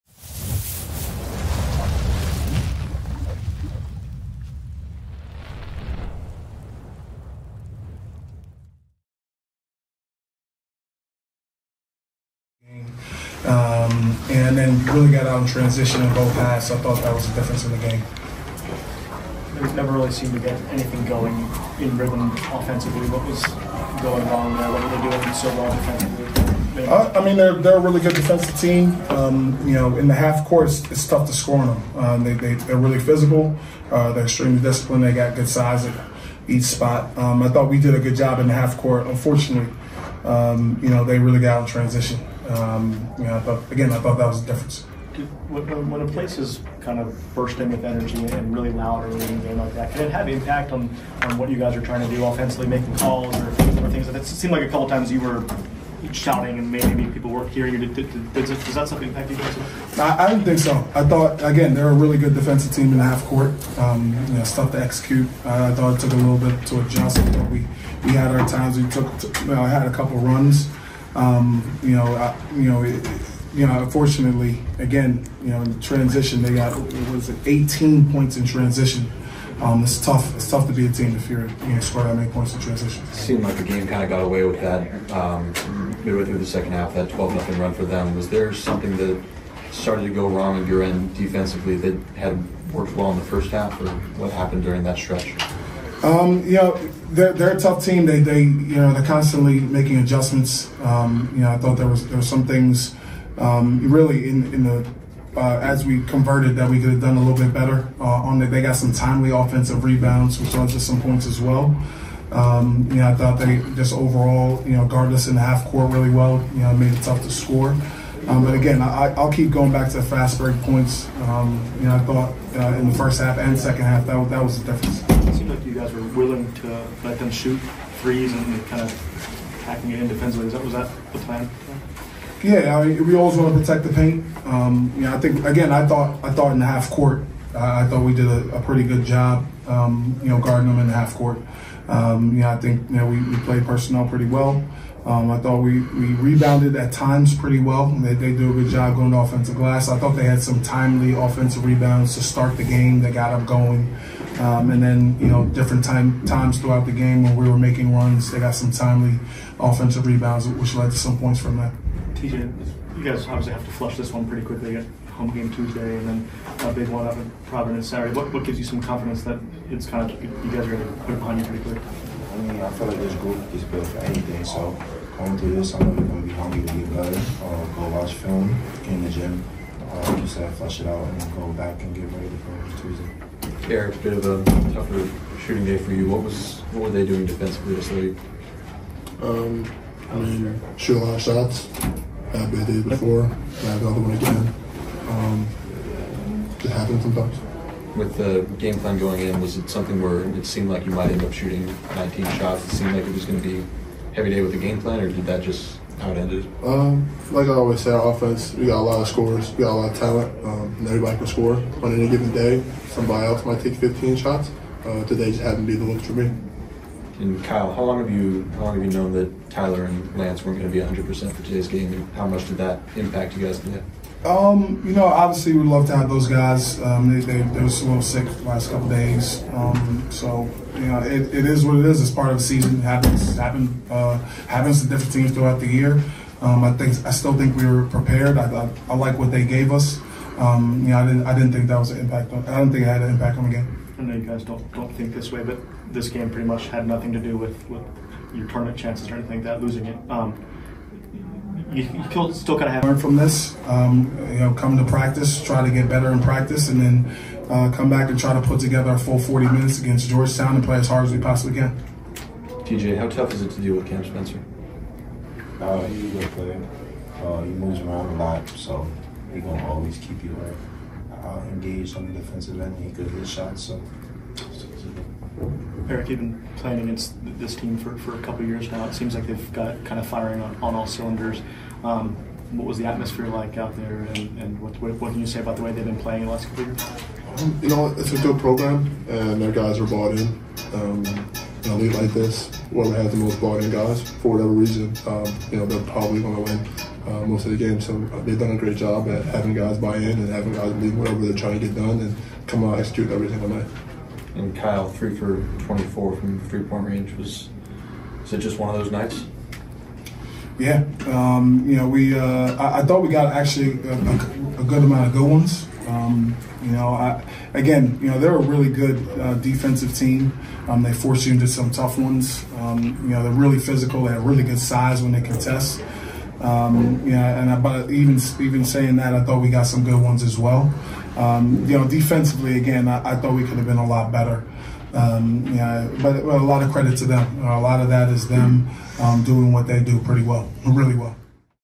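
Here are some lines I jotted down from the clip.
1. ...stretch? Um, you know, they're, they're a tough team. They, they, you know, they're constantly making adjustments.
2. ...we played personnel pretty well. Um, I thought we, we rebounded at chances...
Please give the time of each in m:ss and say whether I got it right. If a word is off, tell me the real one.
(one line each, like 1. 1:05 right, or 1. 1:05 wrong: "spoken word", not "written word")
1. 1:34 right
2. 2:23 wrong: "times", not "chances".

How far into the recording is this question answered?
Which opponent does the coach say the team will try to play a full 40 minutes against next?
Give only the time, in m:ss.
4:20.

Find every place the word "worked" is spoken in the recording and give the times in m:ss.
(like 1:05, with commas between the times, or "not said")
1:32.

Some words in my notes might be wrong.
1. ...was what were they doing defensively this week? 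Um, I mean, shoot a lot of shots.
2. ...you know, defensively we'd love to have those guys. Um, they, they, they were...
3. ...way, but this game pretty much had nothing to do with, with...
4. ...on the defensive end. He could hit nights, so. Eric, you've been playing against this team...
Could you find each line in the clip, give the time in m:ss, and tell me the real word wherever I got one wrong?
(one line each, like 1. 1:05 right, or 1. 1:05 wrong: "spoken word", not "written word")
1. 3:06 right
2. 3:44 wrong: "obviously", not "defensively"
3. 4:05 right
4. 4:31 wrong: "shots", not "nights".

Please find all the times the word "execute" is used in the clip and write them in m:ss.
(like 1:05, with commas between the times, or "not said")
1:04, 5:02.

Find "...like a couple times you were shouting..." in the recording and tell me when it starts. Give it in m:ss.
0:54.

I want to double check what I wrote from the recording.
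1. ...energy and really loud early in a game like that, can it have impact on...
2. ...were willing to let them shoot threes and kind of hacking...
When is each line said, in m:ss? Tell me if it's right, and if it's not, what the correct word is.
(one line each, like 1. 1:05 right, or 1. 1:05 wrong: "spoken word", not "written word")
1. 0:47 right
2. 2:05 right.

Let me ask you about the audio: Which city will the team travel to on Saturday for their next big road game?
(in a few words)
Providence.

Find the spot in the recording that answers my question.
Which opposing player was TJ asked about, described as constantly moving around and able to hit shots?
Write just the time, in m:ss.
4:23.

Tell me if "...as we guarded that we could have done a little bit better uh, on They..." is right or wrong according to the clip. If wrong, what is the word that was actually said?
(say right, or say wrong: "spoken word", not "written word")
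wrong: "converted", not "guarded".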